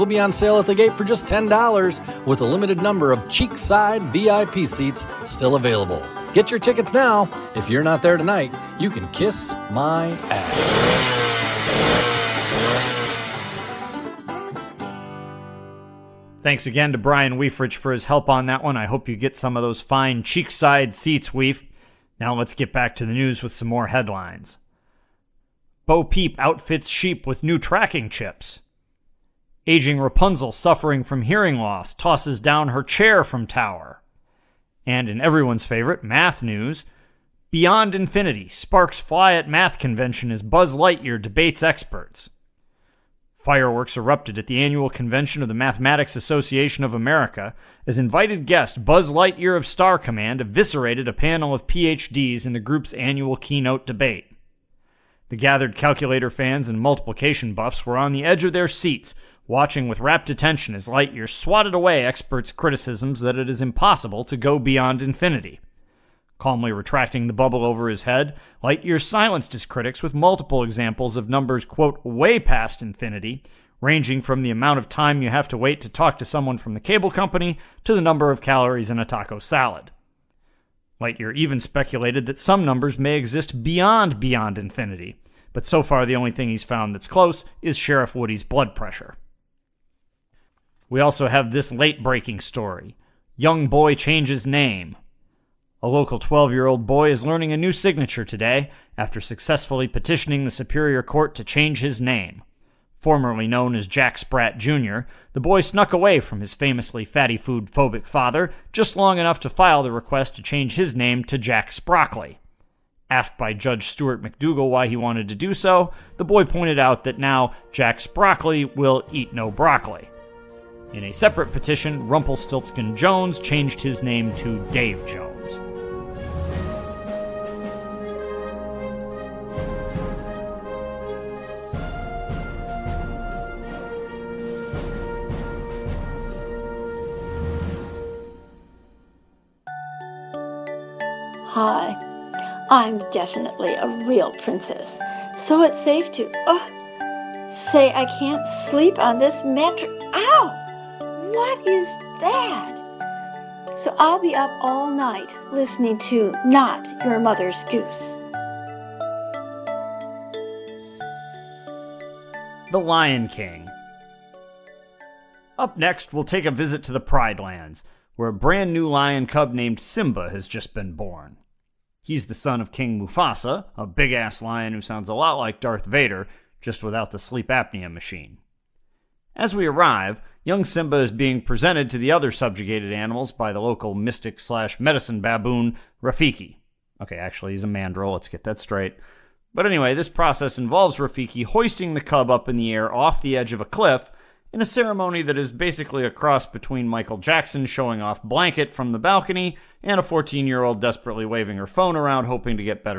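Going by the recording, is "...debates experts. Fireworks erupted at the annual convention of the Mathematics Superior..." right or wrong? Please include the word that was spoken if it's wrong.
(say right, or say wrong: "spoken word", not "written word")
wrong: "Association", not "Superior".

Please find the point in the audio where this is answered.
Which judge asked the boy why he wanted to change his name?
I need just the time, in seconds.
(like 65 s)
113 s.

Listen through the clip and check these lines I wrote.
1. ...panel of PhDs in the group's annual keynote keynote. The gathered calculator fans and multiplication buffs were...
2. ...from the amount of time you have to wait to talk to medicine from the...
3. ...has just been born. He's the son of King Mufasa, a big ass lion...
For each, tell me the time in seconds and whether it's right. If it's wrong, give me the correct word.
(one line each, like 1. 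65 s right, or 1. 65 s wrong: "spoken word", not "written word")
1. 51 s wrong: "debate", not "keynote"
2. 74 s wrong: "someone", not "medicine"
3. 170 s right.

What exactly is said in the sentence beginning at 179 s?
As we arrive, Young Simba is being presented to the other subjugated animals by the local mystic slash medicine baboon, Rafiki.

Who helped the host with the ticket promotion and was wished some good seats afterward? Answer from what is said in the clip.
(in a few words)
Brian Weefridge.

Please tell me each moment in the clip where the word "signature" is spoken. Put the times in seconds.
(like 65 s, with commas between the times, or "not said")
97 s.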